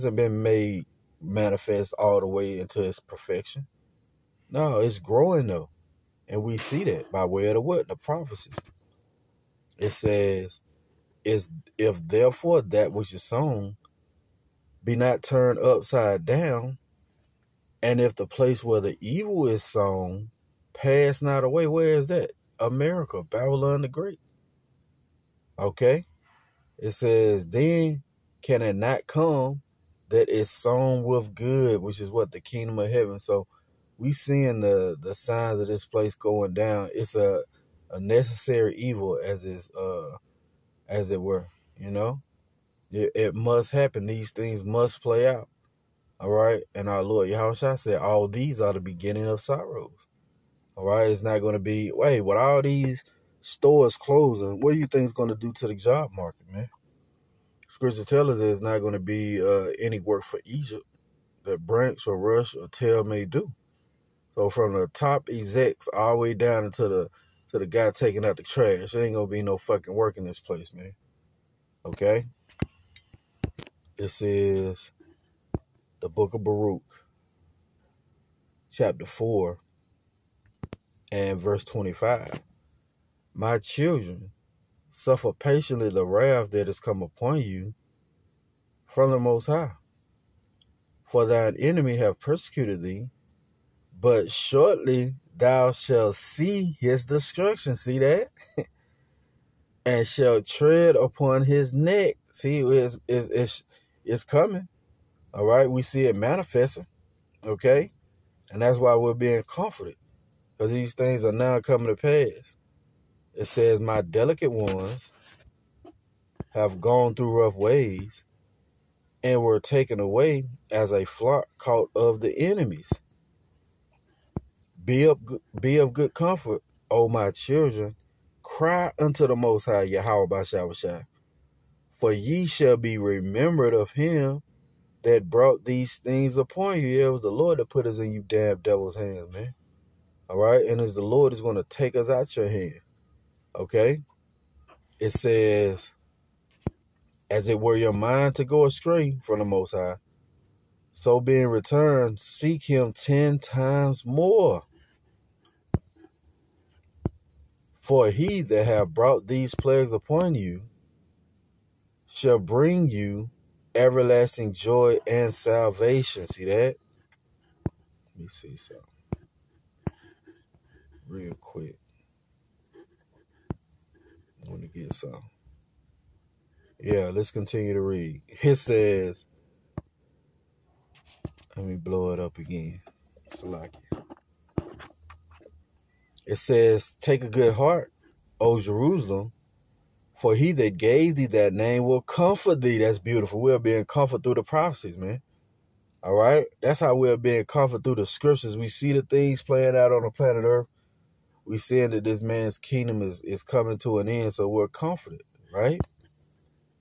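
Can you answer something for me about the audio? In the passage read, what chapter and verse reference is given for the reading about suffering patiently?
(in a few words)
Chapter 4, verse 25.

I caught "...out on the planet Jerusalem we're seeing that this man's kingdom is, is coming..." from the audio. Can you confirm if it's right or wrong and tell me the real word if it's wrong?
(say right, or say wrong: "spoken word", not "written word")
wrong: "Earth", not "Jerusalem".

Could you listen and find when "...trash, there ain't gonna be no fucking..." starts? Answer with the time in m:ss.
1:08.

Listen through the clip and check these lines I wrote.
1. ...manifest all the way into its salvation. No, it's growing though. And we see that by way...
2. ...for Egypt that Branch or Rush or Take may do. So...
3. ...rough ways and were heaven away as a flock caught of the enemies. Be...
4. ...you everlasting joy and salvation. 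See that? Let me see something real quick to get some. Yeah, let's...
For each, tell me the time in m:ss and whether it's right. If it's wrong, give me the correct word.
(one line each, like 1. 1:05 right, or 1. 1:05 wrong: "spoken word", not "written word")
1. 0:01 wrong: "perfection", not "salvation"
2. 1:00 wrong: "Tell", not "Take"
3. 1:57 wrong: "taken", not "heaven"
4. 2:42 right.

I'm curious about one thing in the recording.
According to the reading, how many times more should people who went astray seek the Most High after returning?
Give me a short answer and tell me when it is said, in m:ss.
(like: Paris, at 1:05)
10 times, at 2:32.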